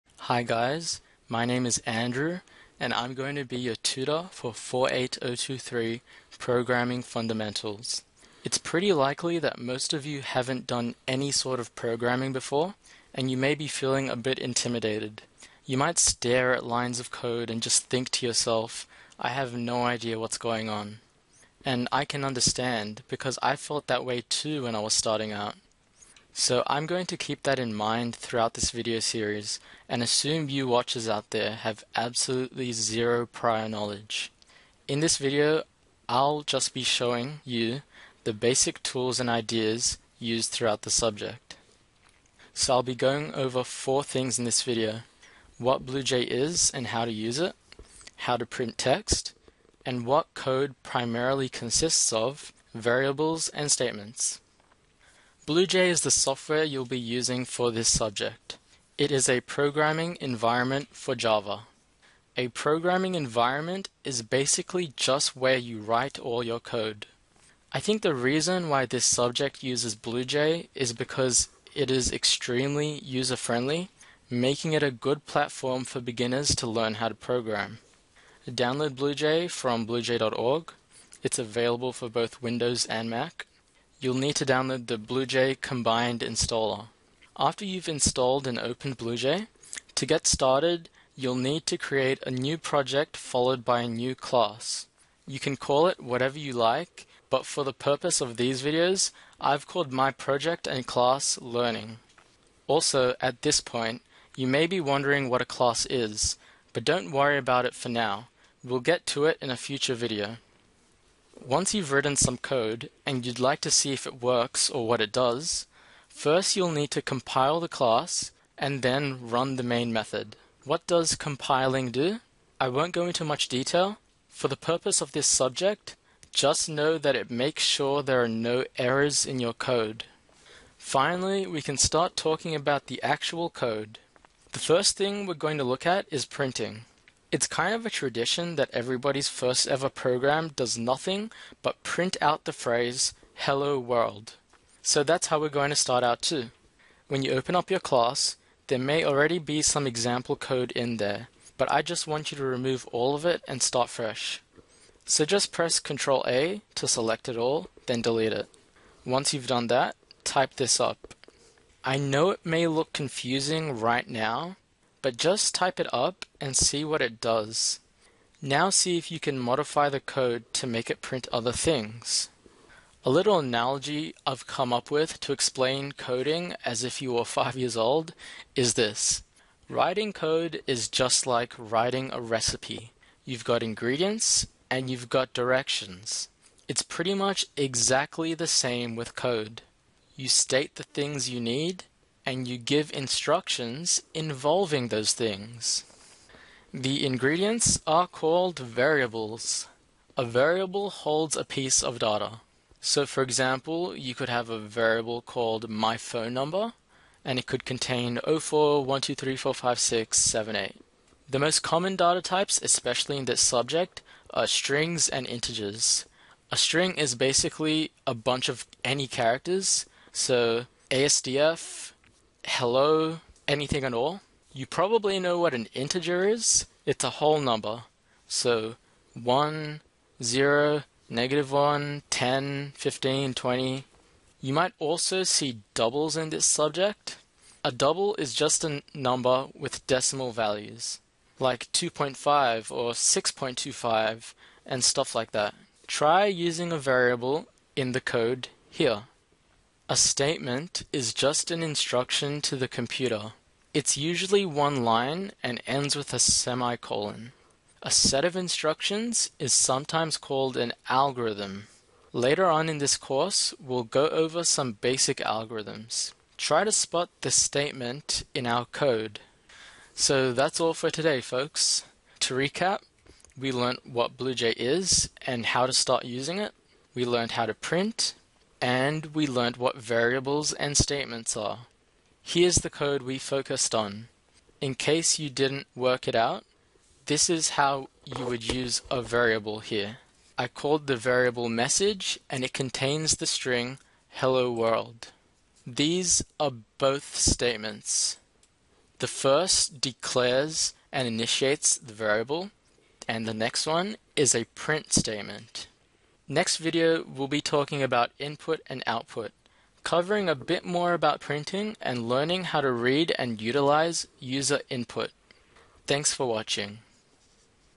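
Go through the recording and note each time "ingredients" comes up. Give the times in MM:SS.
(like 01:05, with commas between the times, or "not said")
03:03, 03:17.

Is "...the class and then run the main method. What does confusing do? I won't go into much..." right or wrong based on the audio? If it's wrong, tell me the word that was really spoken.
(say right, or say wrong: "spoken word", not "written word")
wrong: "compiling", not "confusing".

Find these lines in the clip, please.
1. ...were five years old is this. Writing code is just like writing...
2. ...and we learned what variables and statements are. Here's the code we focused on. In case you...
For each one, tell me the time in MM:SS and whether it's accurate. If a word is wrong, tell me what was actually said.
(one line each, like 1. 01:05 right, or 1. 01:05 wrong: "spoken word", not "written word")
1. 02:57 right
2. 04:38 right.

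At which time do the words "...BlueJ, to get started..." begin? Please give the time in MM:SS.
01:28.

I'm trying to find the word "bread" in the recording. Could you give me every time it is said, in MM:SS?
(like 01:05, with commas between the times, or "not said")
not said.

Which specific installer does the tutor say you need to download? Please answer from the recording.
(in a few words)
BlueJ Combined installer.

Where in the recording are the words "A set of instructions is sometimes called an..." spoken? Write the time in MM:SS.
04:17.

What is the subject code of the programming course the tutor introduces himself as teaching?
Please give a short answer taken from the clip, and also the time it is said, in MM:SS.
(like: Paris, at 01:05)
48023, at 00:04.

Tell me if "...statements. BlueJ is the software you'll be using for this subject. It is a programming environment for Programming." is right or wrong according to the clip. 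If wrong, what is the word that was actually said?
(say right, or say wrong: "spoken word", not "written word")
wrong: "Java", not "Programming".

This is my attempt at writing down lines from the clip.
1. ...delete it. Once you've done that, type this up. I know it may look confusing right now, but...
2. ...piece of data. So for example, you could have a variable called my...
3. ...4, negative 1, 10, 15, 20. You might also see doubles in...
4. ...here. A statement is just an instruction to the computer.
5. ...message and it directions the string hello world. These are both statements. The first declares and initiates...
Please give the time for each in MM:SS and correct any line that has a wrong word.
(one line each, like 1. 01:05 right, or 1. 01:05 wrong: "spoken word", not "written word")
1. 02:38 right
2. 03:21 right
3. 03:50 wrong: "0", not "4"
4. 04:08 right
5. 04:51 wrong: "contains", not "directions".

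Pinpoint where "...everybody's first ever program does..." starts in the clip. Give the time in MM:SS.
02:18.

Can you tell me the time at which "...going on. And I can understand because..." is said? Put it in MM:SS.
00:20.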